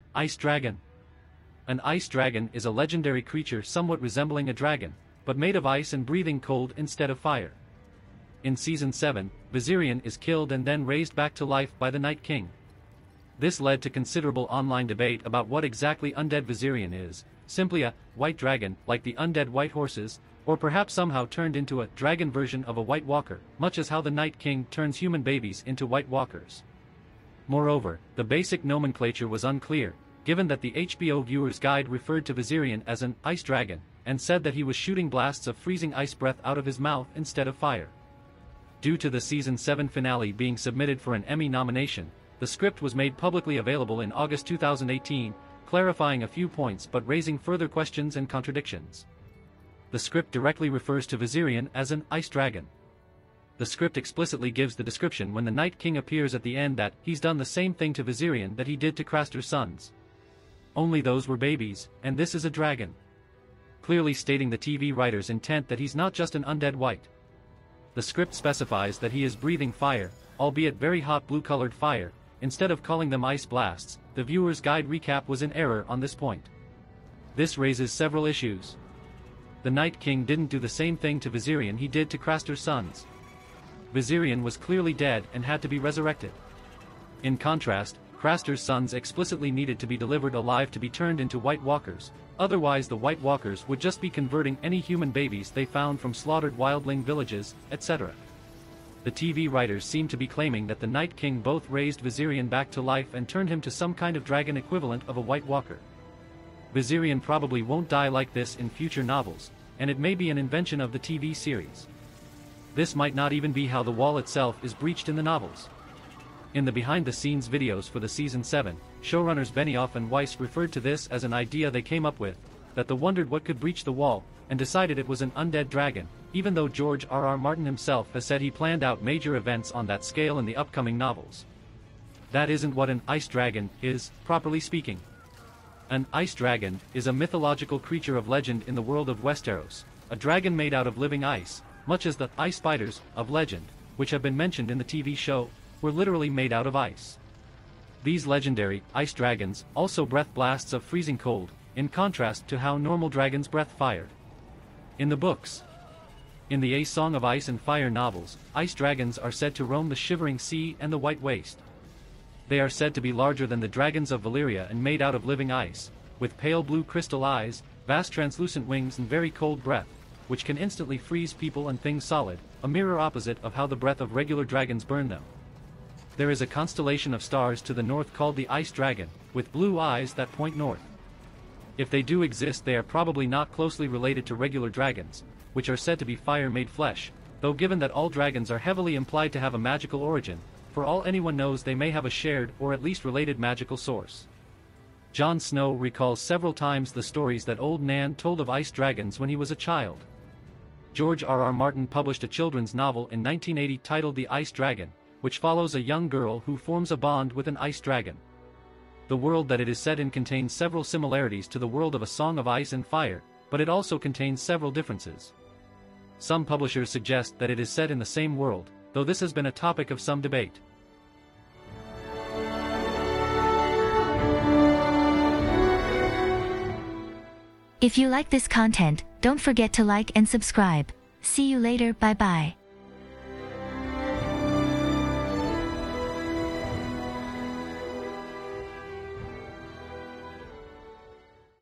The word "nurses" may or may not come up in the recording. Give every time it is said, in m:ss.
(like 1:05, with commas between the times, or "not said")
not said.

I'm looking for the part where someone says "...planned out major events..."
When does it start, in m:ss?
2:08.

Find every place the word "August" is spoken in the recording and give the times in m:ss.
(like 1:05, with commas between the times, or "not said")
0:44.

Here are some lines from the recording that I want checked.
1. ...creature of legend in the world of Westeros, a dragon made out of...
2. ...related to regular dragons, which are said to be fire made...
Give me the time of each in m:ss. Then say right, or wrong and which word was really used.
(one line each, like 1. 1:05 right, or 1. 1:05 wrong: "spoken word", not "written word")
1. 2:17 right
2. 3:03 right.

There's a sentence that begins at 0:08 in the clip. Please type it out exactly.
In Season 7, Viserion is killed and then raised back to life by the Night King.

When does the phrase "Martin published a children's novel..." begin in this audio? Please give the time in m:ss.
3:21.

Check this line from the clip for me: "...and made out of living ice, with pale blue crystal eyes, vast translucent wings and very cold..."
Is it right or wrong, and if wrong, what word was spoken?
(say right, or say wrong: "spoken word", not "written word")
right.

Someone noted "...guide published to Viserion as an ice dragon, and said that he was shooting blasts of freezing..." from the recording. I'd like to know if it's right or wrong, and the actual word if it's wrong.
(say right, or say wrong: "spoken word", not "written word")
wrong: "referred", not "published".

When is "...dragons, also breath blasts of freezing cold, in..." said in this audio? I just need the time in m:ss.
2:29.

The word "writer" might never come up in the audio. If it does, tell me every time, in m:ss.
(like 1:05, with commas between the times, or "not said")
1:04, 1:39.